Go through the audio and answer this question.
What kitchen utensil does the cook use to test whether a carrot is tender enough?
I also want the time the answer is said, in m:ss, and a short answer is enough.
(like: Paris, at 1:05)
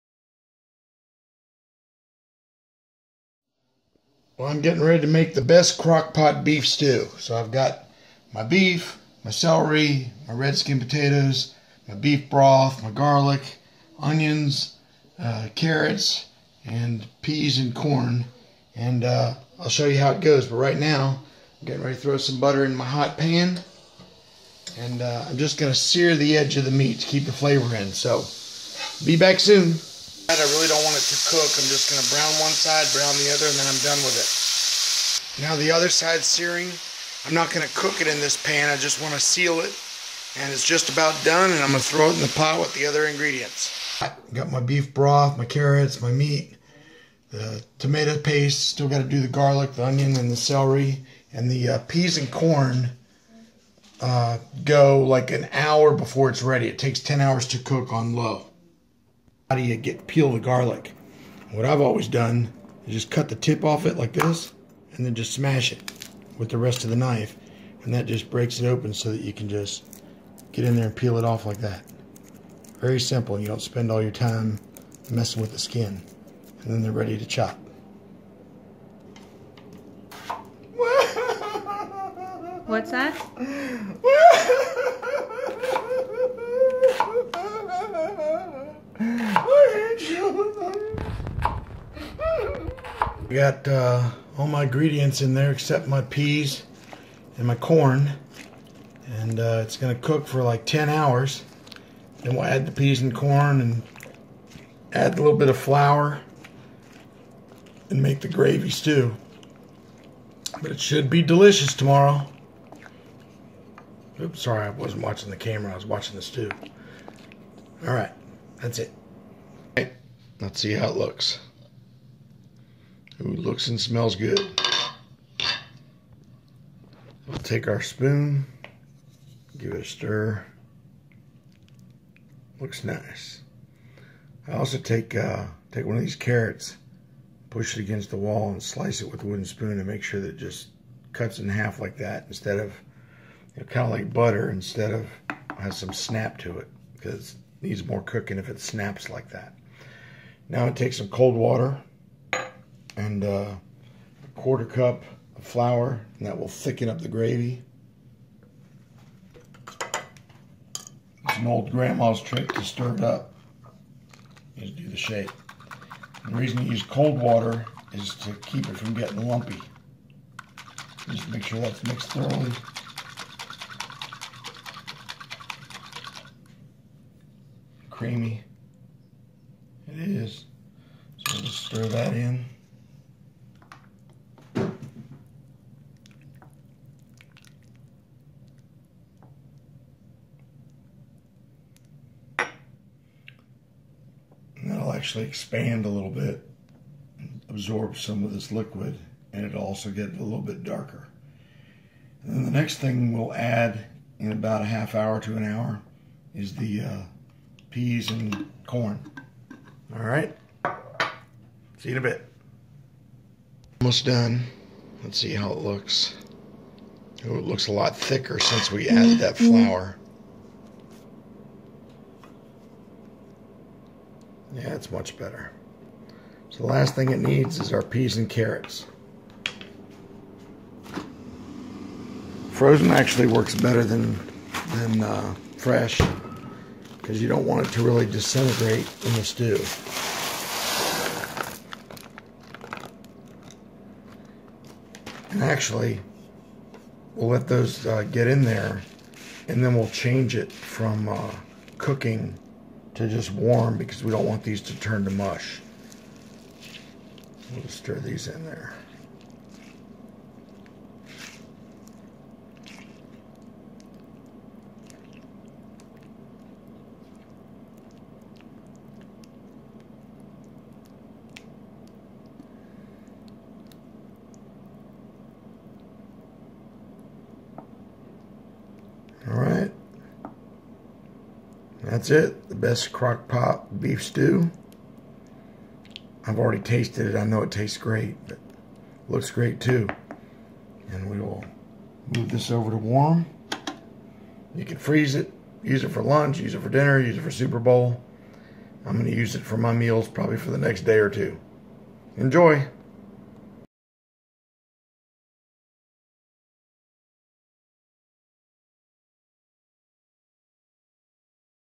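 wooden spoon, at 2:19.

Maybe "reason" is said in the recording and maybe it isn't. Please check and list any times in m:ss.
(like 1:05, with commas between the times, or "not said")
2:46.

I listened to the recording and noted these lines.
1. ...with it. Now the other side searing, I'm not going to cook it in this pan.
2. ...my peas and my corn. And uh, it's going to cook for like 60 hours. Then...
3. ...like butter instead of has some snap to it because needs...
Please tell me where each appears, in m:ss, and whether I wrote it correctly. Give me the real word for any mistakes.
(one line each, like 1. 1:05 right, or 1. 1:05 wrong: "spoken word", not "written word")
1. 0:33 right
2. 1:35 wrong: "10", not "60"
3. 2:23 right.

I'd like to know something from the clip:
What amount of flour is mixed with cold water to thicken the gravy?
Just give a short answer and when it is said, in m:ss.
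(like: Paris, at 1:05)
a quarter cup, at 2:33.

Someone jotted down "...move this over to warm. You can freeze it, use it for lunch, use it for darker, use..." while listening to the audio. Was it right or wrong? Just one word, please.
wrong.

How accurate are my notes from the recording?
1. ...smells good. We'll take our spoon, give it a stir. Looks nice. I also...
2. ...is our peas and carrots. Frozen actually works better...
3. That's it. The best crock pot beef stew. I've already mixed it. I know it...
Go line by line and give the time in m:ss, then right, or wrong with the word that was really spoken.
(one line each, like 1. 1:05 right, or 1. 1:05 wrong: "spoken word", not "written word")
1. 2:03 right
2. 3:47 right
3. 4:41 wrong: "tasted", not "mixed".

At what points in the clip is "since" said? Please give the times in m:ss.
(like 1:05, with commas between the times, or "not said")
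3:38.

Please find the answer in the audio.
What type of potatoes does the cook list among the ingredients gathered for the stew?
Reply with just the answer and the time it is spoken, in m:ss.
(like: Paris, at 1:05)
red skin potatoes, at 0:10.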